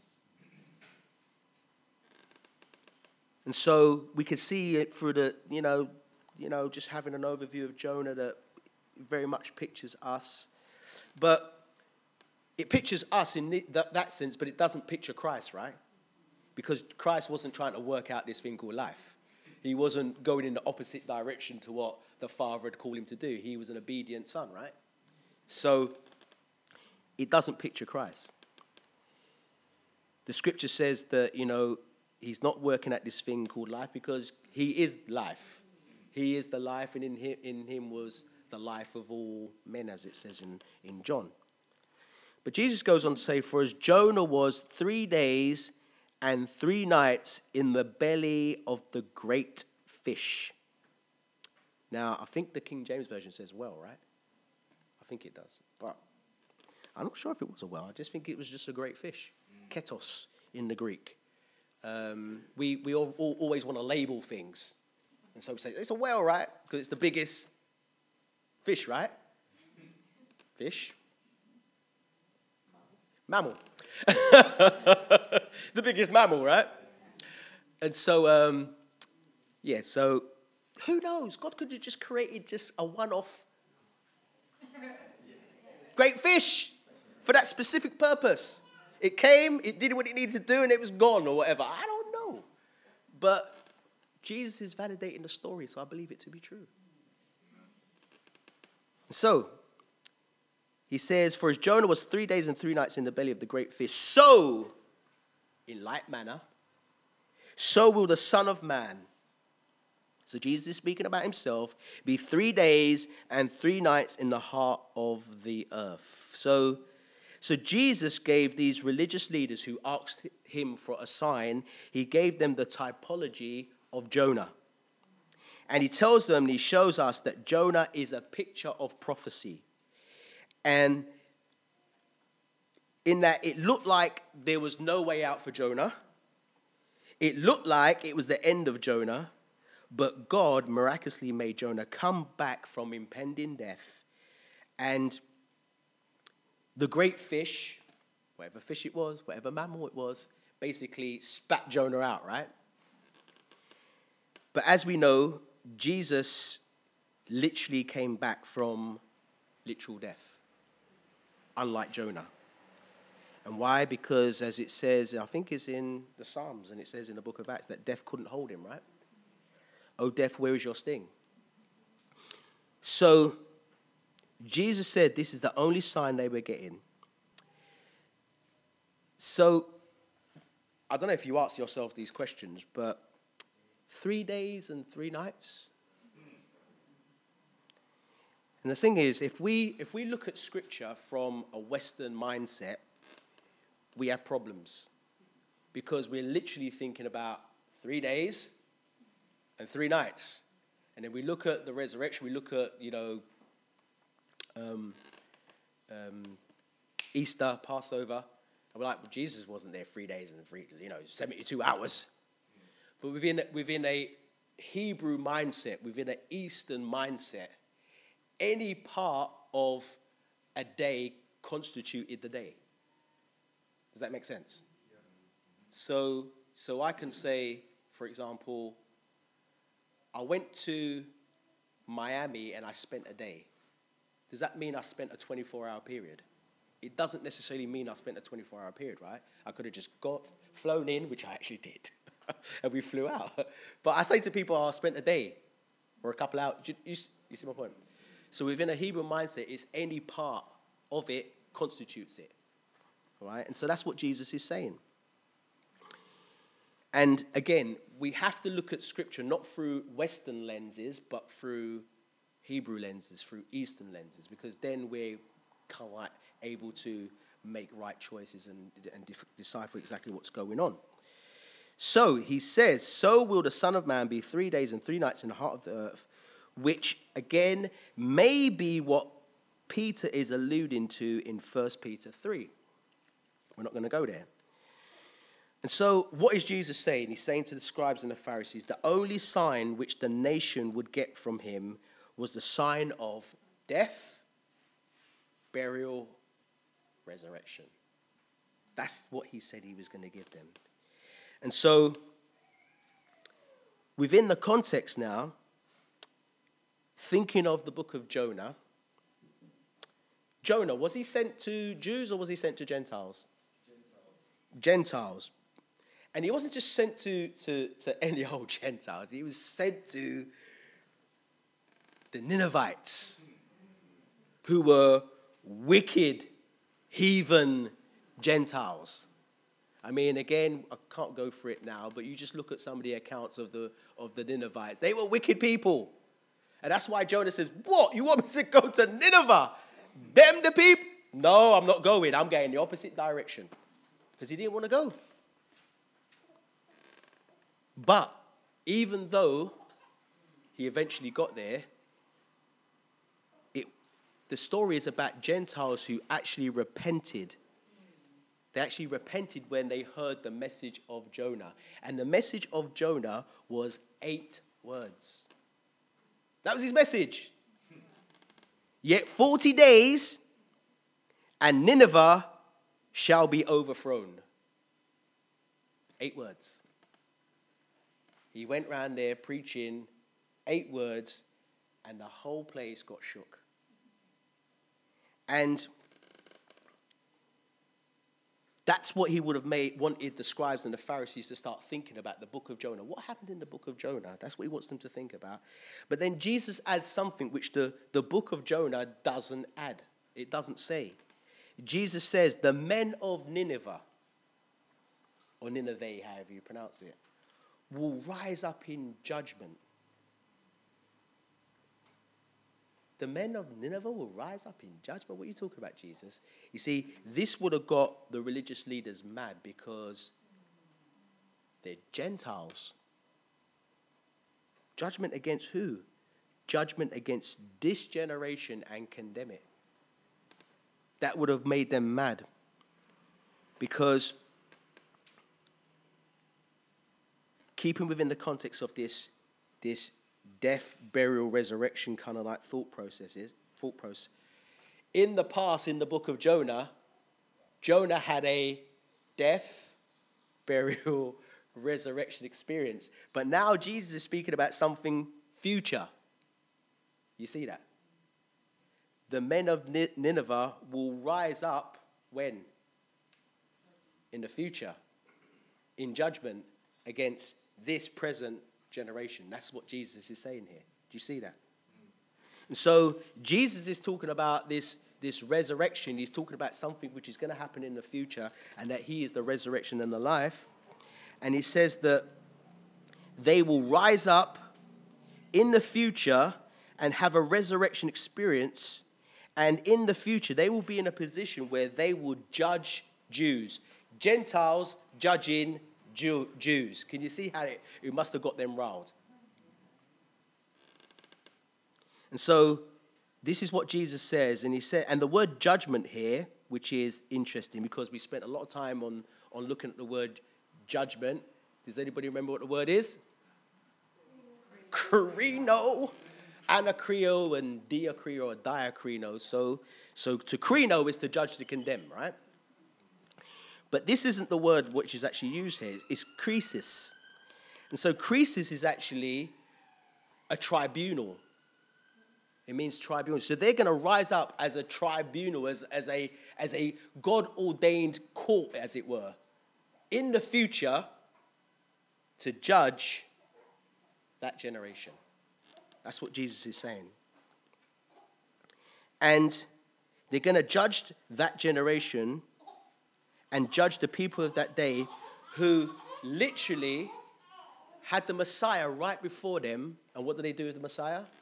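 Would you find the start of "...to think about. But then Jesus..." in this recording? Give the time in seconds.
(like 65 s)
394 s.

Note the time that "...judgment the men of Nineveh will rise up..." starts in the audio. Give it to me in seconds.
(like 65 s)
409 s.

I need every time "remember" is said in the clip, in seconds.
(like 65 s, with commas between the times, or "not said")
512 s.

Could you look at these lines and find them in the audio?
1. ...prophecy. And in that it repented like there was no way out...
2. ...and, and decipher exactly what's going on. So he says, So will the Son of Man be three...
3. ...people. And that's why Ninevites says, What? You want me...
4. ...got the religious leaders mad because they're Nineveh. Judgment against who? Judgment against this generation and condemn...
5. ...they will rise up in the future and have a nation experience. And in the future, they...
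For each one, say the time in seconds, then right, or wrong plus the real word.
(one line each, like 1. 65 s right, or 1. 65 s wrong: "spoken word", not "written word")
1. 129 s wrong: "looked", not "repented"
2. 268 s right
3. 335 s wrong: "Jonah", not "Ninevites"
4. 417 s wrong: "Gentiles", not "Nineveh"
5. 483 s wrong: "resurrection", not "nation".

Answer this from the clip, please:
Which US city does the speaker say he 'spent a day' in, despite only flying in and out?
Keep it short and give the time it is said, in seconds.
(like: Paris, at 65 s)
Miami, at 231 s.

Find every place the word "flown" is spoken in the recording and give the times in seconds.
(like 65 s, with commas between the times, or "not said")
240 s.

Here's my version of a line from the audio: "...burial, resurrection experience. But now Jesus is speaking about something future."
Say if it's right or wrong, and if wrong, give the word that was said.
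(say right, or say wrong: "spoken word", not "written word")
right.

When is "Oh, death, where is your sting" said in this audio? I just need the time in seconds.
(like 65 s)
169 s.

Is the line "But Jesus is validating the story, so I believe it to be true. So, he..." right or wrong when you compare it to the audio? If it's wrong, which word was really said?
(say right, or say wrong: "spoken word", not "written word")
right.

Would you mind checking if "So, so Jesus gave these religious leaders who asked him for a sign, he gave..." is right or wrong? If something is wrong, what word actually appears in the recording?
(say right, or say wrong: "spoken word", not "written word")
right.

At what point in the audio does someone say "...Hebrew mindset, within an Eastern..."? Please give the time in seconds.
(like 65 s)
214 s.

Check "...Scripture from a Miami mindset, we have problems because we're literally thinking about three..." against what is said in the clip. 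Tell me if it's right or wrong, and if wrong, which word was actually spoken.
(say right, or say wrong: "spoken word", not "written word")
wrong: "Western", not "Miami".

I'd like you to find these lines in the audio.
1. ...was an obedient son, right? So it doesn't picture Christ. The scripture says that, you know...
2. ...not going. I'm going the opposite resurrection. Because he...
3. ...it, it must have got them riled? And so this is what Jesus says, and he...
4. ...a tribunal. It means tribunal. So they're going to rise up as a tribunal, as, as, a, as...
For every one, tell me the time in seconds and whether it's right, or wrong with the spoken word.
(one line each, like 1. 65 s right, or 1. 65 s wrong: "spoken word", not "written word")
1. 23 s right
2. 341 s wrong: "direction", not "resurrection"
3. 497 s right
4. 530 s right.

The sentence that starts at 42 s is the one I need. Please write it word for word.
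But Jesus goes on to say, For as Jonah was three days and three nights in the belly of the great fish.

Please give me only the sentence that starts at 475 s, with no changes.
He's talking about something which is going to happen in the future and that he is the resurrection and the life.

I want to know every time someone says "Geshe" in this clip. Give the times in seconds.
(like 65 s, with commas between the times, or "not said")
not said.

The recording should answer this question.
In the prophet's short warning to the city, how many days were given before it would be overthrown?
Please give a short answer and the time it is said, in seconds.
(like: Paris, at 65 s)
40, at 369 s.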